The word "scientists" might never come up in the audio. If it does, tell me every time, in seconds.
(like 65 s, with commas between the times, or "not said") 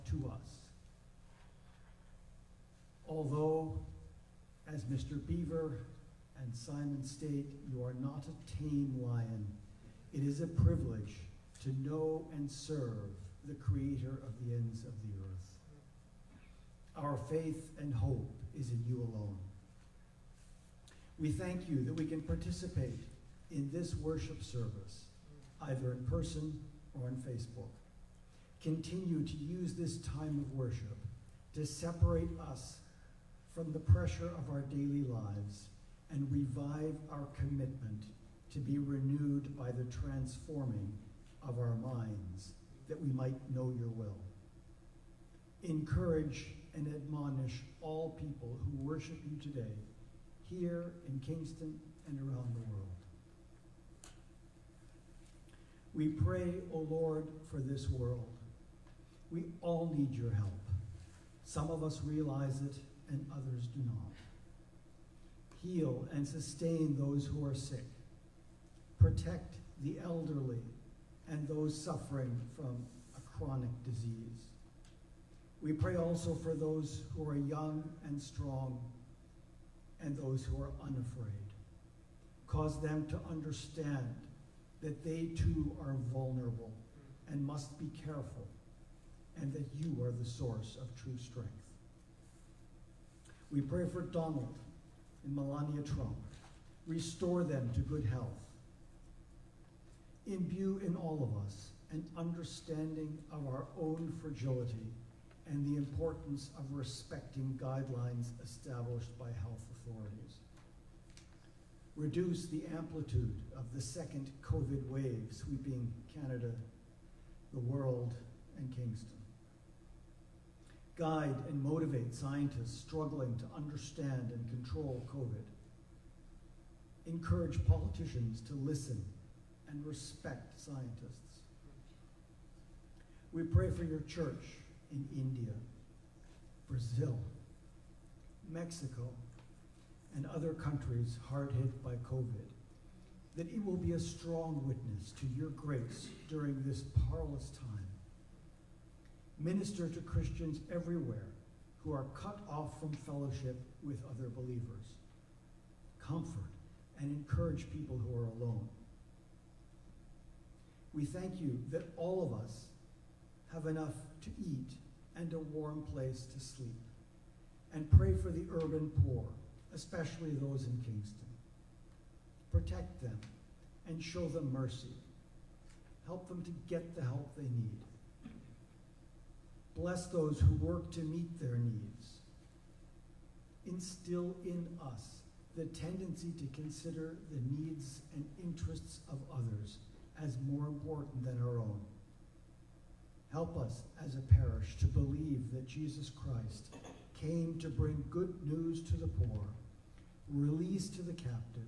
122 s, 130 s.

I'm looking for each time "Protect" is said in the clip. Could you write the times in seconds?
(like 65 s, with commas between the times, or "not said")
68 s, 172 s.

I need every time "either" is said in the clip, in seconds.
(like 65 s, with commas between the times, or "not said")
25 s.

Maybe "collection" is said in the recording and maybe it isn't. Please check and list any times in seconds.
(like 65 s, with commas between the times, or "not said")
not said.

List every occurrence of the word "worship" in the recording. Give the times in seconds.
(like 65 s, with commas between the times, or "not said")
23 s, 30 s, 48 s.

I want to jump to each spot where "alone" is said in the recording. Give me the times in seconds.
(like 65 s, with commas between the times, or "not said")
19 s, 158 s.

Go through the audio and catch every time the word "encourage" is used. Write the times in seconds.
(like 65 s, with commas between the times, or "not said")
45 s, 127 s, 157 s.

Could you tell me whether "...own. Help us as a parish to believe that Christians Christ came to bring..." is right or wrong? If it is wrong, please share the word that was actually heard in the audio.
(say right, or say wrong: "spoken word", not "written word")
wrong: "Jesus", not "Christians".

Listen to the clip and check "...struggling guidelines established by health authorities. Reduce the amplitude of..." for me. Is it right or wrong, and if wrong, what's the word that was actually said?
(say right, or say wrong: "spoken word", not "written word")
wrong: "respecting", not "struggling".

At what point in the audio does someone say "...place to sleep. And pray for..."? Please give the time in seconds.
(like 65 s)
165 s.